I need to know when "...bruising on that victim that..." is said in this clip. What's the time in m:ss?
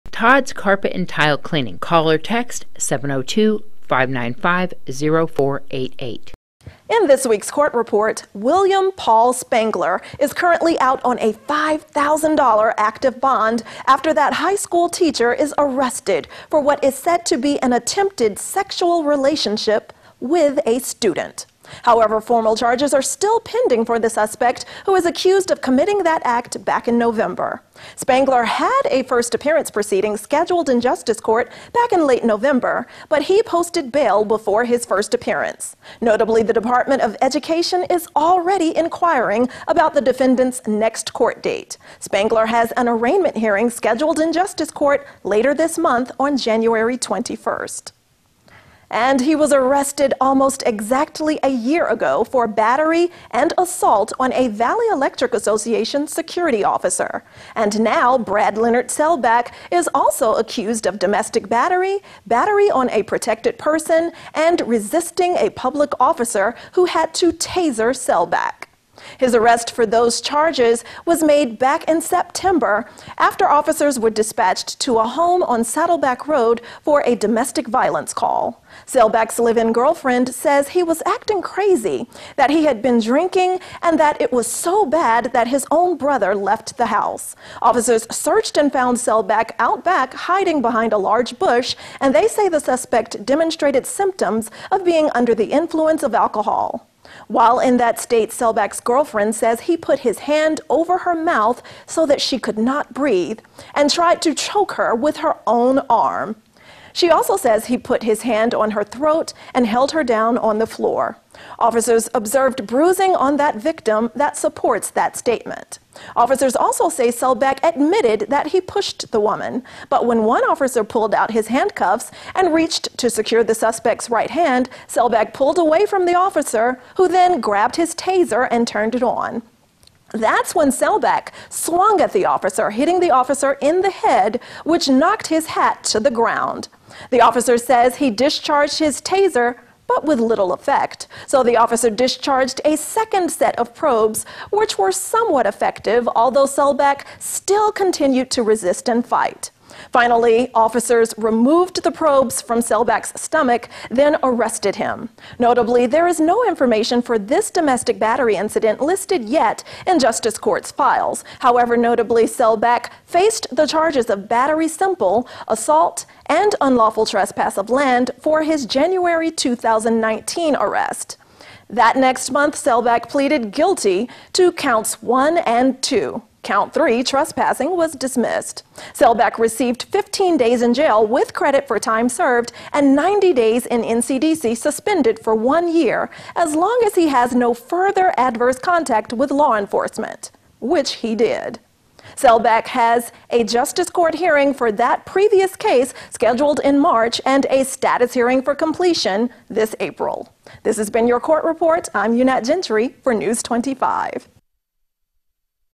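1:52.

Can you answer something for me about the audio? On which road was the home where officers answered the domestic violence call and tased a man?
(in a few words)
Saddleback Road.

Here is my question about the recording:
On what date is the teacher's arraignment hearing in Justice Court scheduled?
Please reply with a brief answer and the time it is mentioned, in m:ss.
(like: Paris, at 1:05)
January 21st, at 0:46.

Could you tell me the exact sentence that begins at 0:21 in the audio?
However, formal charges are still pending for the suspect, who is accused of committing that act back in November.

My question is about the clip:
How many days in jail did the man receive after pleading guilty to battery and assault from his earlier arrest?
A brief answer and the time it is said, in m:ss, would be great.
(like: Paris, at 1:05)
15, at 2:59.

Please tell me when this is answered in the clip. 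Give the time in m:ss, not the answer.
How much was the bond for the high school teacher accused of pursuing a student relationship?
0:11.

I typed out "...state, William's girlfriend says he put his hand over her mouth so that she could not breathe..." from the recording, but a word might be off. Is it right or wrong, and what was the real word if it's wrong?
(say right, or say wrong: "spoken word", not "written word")
wrong: "Selbach", not "William".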